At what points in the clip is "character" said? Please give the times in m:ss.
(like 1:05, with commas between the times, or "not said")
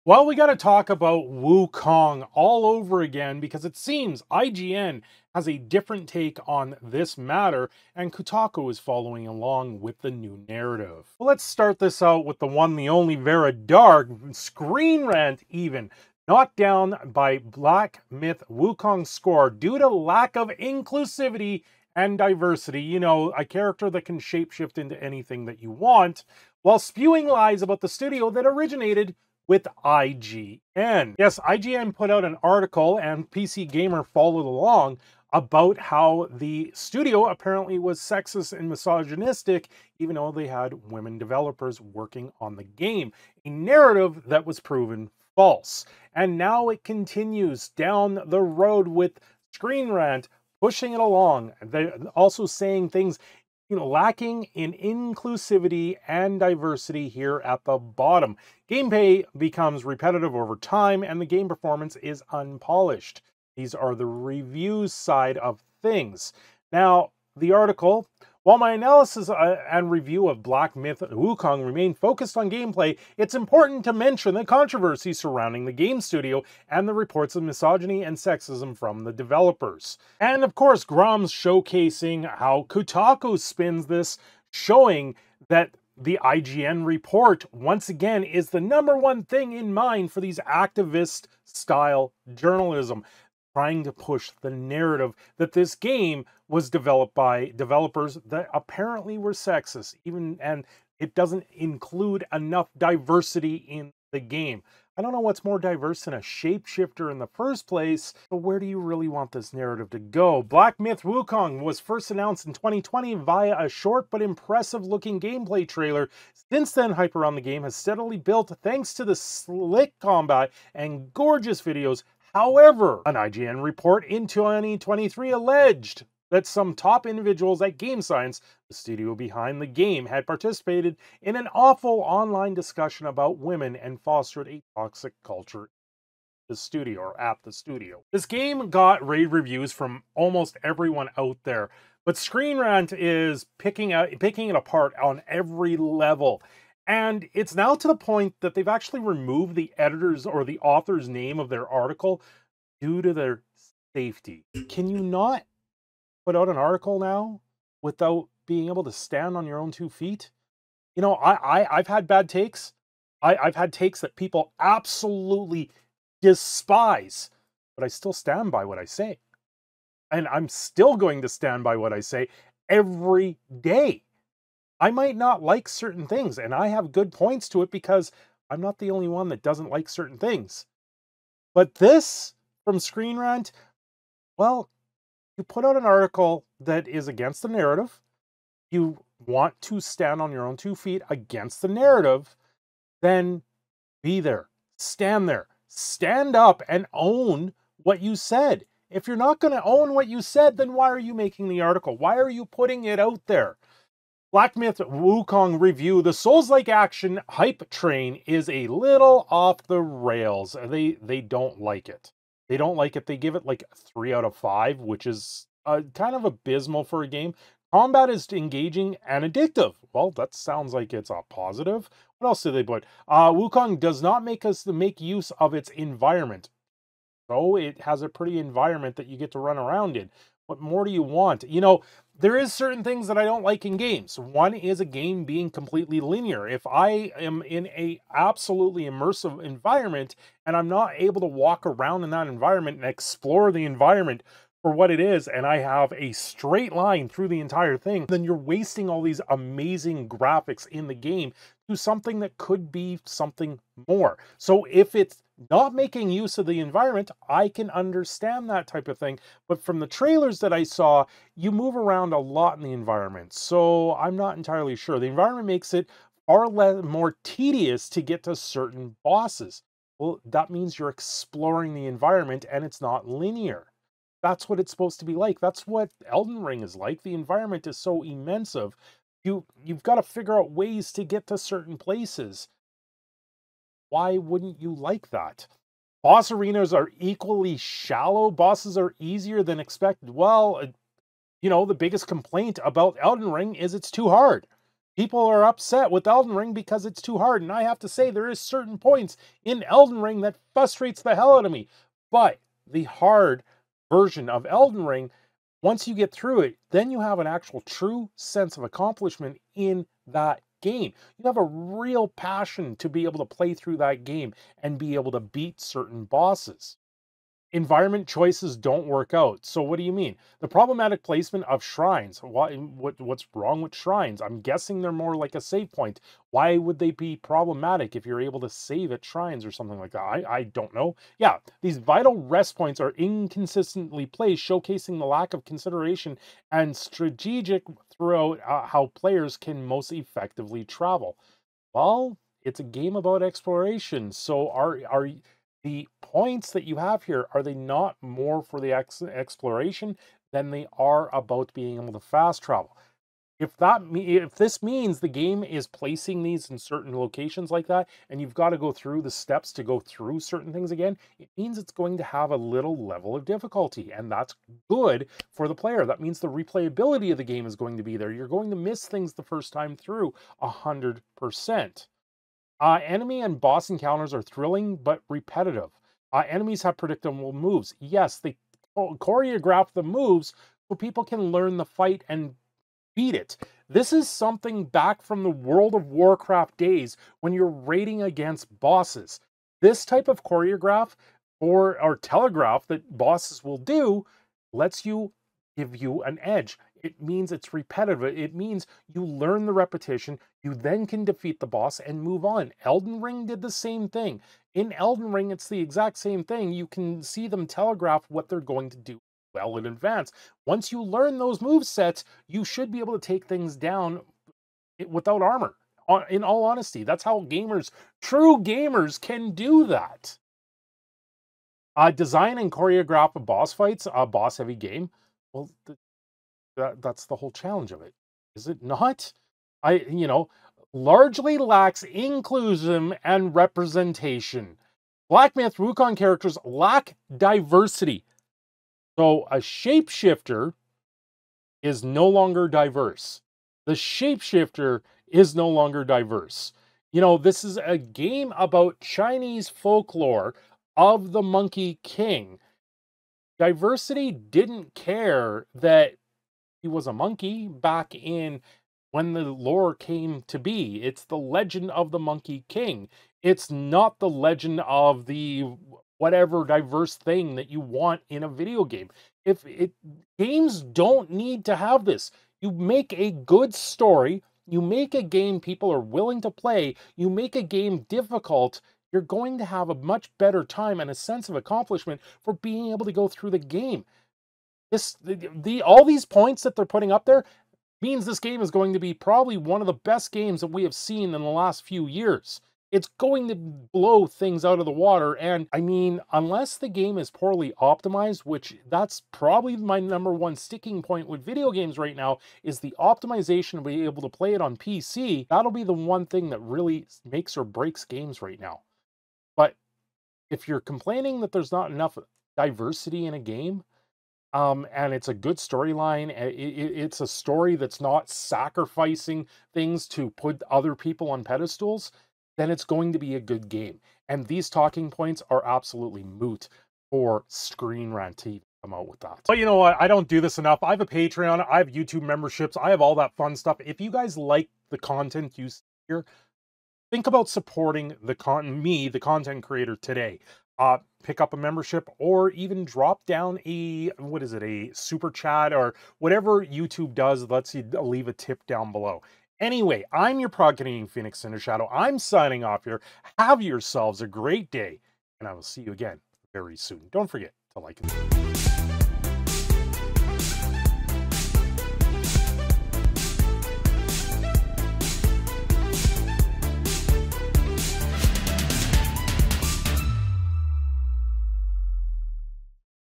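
0:23, 7:15.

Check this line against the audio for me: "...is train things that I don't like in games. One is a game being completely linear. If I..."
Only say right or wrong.
wrong.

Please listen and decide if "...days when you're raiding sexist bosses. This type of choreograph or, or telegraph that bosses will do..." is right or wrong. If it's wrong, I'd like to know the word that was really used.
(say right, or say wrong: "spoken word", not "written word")
wrong: "against", not "sexist".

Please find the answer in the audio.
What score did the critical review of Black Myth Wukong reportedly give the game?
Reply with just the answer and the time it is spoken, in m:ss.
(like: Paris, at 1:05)
3 out of 5, at 3:33.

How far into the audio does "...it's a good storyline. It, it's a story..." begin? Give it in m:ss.
8:34.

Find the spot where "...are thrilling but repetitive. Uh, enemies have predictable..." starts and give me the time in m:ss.
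6:14.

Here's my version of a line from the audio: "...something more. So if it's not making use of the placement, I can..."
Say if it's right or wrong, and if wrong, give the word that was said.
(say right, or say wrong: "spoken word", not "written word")
wrong: "environment", not "placement".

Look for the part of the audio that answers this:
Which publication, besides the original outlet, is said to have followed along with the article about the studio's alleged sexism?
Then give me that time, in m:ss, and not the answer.
0:33.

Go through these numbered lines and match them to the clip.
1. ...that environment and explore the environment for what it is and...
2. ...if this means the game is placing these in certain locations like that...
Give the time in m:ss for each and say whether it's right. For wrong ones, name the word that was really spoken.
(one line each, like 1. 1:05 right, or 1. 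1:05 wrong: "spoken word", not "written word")
1. 4:02 right
2. 5:53 right.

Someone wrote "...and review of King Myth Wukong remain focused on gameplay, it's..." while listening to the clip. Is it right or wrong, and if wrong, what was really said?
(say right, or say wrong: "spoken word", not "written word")
wrong: "Black", not "King".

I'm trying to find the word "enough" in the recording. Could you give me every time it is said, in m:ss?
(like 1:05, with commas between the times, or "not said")
1:42, 8:31, 8:50.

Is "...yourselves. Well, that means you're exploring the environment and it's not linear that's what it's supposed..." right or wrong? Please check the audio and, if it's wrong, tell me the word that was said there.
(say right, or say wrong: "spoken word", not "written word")
wrong: "bosses", not "yourselves".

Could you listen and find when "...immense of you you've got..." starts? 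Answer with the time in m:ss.
4:38.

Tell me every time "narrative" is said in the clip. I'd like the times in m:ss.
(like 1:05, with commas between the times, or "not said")
0:10, 0:43, 1:34, 1:49, 3:07, 3:11.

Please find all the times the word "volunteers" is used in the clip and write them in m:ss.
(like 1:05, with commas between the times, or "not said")
not said.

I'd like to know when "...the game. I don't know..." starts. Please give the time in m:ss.
1:44.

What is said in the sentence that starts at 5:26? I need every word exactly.
Why would they be problematic if you're able to save at shrines or something like that?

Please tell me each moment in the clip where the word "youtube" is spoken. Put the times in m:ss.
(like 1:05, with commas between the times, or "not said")
8:51, 9:06.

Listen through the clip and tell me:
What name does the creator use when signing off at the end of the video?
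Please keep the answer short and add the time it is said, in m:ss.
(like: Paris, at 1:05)
Prog Phoenix Cindershadow, at 9:10.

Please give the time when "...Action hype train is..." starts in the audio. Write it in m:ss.
3:26.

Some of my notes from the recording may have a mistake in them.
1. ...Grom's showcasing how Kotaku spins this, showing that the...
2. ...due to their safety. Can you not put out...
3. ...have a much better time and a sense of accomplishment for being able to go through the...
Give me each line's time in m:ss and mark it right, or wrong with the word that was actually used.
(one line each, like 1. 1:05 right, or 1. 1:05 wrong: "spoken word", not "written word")
1. 1:20 right
2. 2:32 right
3. 7:59 right.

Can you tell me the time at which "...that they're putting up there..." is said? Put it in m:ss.
8:06.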